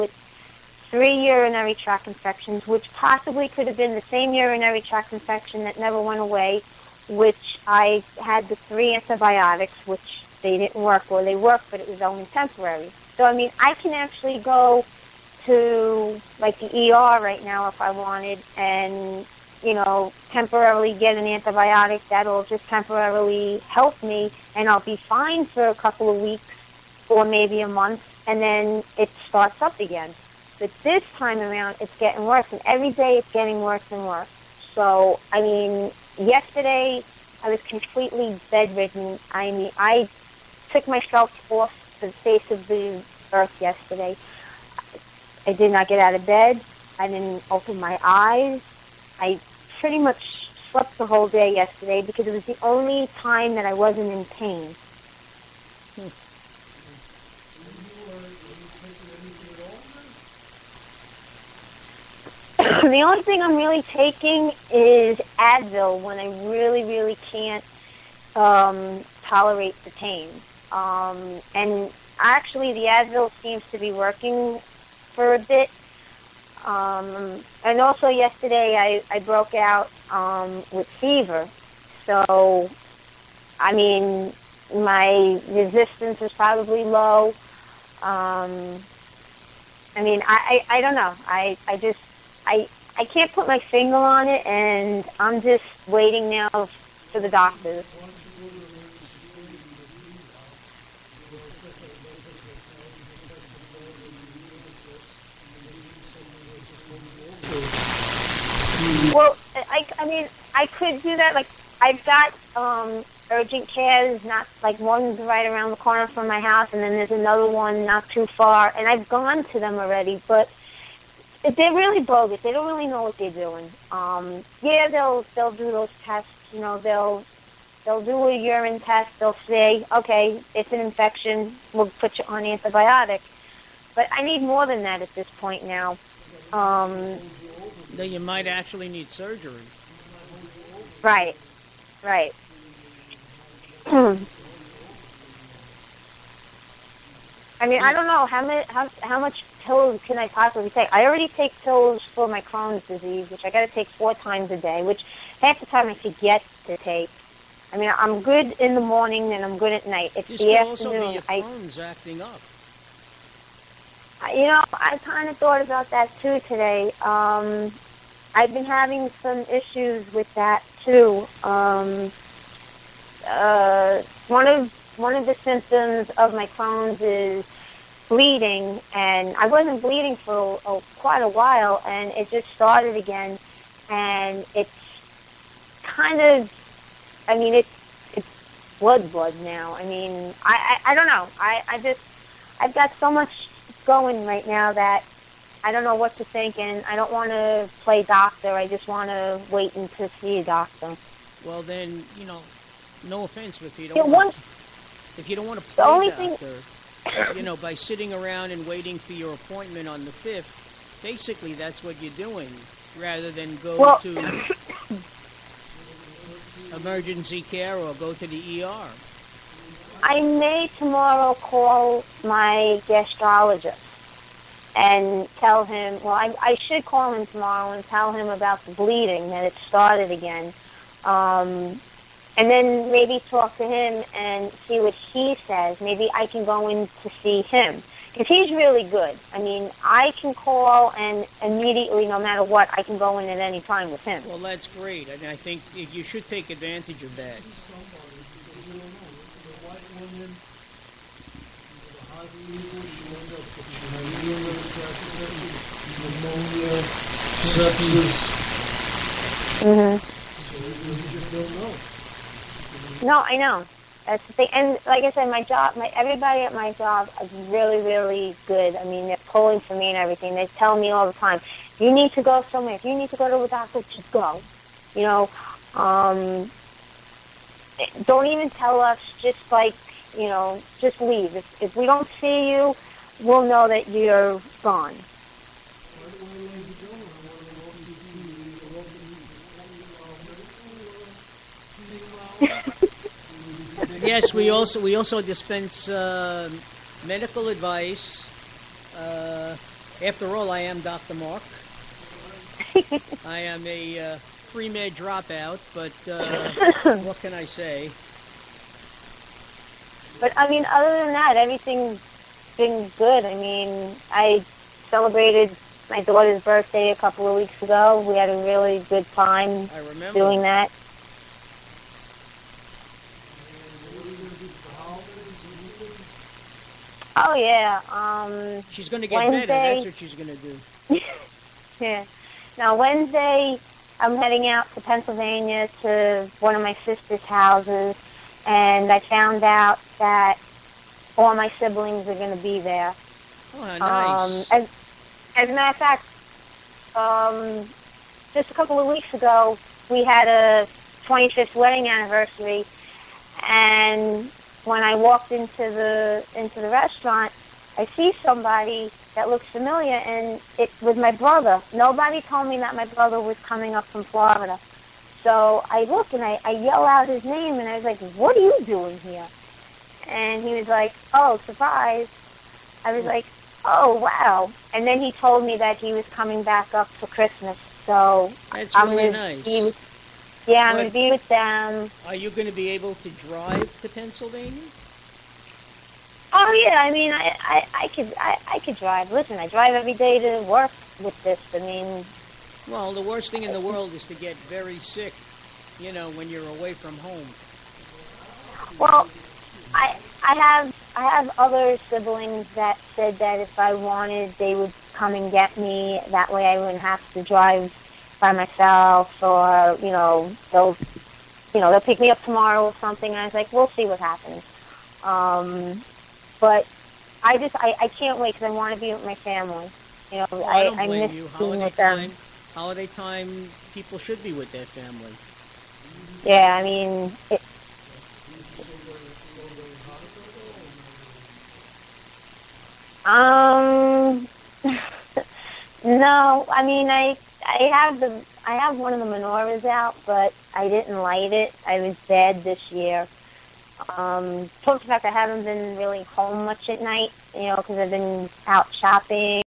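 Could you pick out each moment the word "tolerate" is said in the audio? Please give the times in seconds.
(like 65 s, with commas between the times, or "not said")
69 s.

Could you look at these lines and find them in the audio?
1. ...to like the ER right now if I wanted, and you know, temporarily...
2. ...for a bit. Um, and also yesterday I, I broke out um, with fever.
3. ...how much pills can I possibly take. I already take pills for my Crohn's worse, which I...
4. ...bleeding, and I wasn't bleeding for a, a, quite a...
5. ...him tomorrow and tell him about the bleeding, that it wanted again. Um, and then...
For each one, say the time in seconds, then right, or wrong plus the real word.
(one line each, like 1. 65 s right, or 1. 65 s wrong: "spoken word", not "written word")
1. 15 s right
2. 75 s right
3. 149 s wrong: "disease", not "worse"
4. 178 s right
5. 227 s wrong: "started", not "wanted".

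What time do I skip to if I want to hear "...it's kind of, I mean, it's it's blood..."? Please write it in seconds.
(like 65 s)
184 s.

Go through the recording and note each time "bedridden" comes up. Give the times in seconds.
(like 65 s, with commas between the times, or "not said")
38 s.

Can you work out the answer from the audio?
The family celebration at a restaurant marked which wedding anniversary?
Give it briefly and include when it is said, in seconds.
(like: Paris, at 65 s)
25th, at 350 s.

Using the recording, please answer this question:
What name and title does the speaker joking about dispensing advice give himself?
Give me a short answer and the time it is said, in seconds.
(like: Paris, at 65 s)
Dr. Mark, at 300 s.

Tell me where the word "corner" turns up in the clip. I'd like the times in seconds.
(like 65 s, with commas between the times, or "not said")
115 s.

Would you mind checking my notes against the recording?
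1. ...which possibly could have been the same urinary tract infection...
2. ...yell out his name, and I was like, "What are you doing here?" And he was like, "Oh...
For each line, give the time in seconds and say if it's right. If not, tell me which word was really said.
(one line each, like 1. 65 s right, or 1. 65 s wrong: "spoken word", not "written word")
1. 2 s right
2. 366 s right.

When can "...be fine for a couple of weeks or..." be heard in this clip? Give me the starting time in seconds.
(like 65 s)
24 s.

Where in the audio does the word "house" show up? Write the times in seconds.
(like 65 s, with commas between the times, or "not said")
116 s, 337 s.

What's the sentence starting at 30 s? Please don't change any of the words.
But this time around, it's getting worse, and every day it's getting worse and worse.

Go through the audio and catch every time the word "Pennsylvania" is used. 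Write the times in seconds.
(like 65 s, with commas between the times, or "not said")
334 s, 383 s.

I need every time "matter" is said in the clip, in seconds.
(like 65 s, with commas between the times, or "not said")
242 s, 345 s.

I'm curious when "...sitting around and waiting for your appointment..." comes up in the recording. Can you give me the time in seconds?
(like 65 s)
207 s.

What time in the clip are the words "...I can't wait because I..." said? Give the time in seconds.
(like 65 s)
417 s.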